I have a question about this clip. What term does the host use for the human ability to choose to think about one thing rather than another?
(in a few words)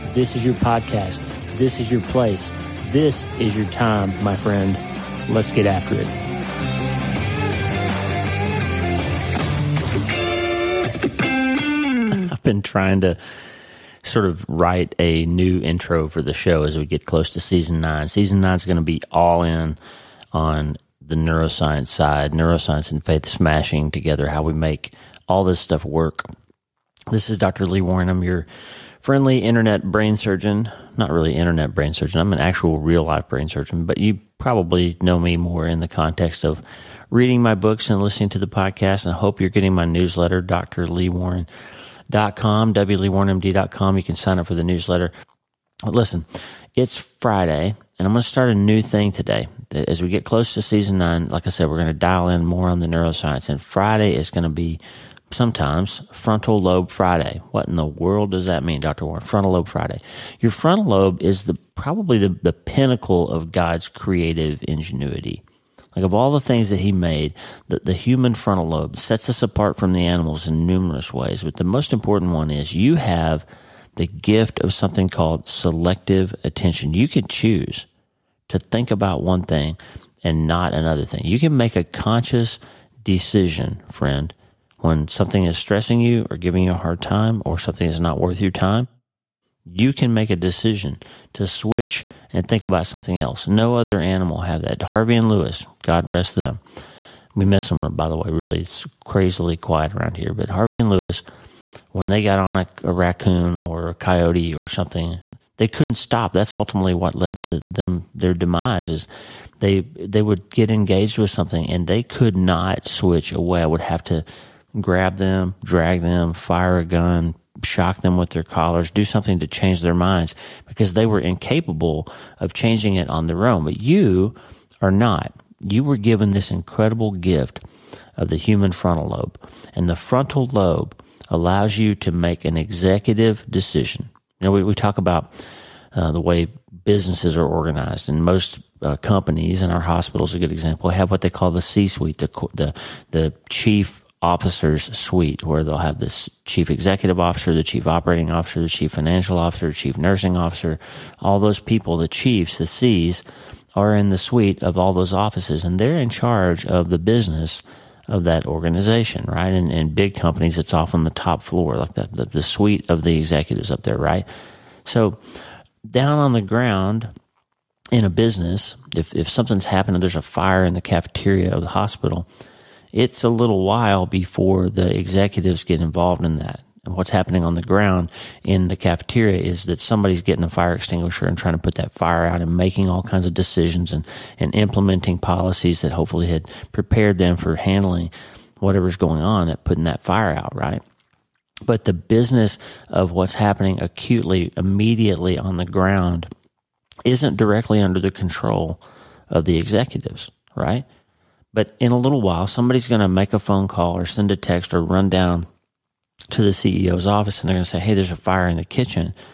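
Selective attention.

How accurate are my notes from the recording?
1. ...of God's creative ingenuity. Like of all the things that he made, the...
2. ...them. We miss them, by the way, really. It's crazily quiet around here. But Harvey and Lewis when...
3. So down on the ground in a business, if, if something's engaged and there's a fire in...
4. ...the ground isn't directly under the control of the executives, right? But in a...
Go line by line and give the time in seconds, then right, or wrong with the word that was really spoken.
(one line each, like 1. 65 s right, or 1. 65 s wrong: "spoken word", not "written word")
1. 63 s right
2. 96 s right
3. 164 s wrong: "happened", not "engaged"
4. 195 s right.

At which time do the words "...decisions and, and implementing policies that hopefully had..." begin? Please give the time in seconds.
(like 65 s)
183 s.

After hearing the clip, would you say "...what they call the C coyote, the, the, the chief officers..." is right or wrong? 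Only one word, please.
wrong.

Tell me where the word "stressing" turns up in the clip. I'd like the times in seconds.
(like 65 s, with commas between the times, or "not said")
85 s.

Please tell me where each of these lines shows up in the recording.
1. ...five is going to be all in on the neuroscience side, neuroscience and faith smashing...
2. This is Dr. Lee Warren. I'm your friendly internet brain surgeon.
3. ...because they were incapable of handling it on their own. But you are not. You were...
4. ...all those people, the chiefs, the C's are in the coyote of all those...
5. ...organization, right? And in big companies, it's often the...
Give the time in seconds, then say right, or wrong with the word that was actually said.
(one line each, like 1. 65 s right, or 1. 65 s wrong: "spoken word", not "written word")
1. 18 s wrong: "nine", not "five"
2. 27 s right
3. 120 s wrong: "changing", not "handling"
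4. 151 s wrong: "suite", not "coyote"
5. 158 s right.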